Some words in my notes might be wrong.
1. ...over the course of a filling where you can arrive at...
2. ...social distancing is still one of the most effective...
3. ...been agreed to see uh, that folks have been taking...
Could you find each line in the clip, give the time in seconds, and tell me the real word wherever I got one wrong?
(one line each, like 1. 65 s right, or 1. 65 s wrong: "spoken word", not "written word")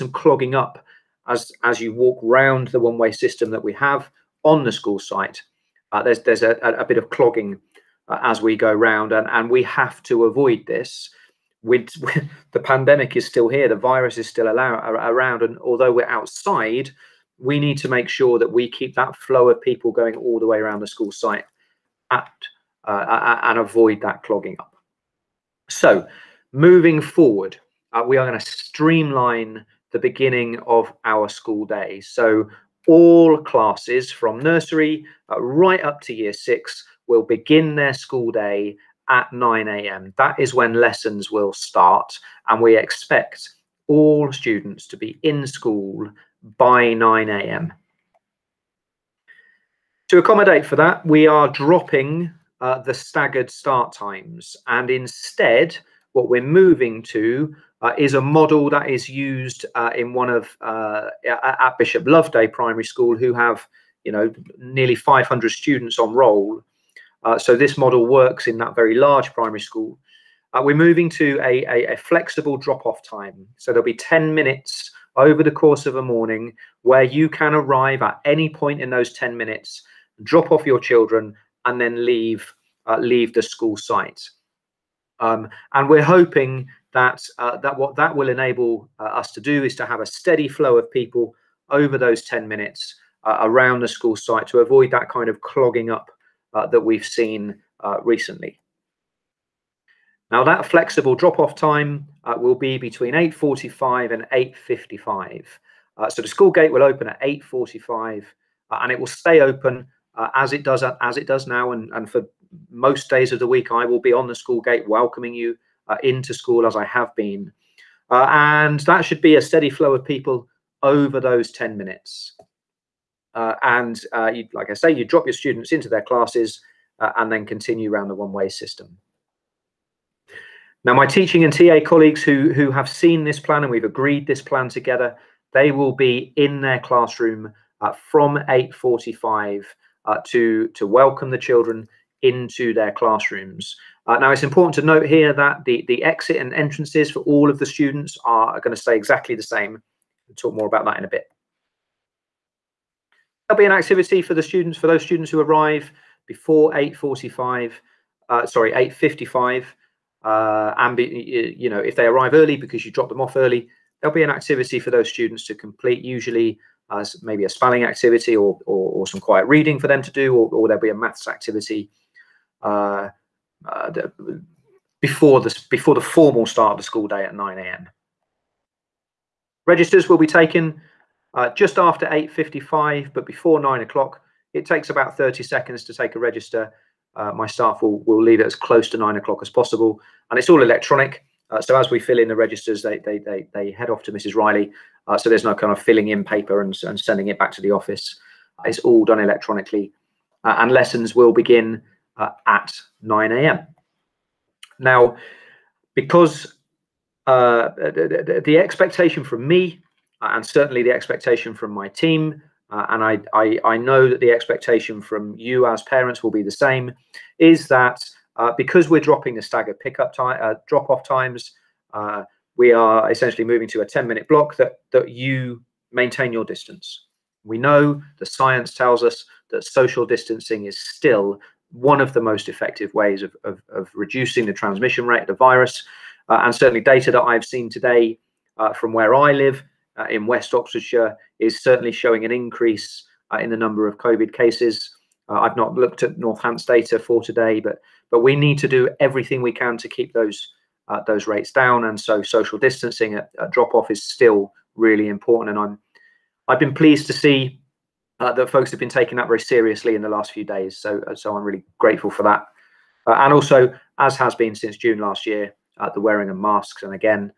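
1. 75 s wrong: "morning", not "filling"
2. 229 s right
3. 256 s wrong: "pleased", not "agreed".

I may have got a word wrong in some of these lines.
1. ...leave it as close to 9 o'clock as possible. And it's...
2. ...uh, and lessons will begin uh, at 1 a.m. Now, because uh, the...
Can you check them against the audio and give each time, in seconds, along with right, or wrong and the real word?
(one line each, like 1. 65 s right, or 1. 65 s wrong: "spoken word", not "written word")
1. 188 s right
2. 200 s wrong: "9", not "1".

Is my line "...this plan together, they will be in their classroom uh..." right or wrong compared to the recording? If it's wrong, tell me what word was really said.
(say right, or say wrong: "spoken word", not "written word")
right.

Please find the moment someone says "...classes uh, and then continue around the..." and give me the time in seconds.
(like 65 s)
126 s.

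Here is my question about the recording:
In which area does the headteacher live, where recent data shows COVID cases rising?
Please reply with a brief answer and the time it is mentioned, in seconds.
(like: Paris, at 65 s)
West Oxfordshire, at 240 s.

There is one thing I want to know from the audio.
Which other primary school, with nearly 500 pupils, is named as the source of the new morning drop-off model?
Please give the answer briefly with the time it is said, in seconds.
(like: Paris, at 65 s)
Bishop Loveday Primary School, at 61 s.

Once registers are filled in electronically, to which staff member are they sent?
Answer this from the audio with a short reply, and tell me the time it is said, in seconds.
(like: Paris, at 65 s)
Mrs. Riley, at 194 s.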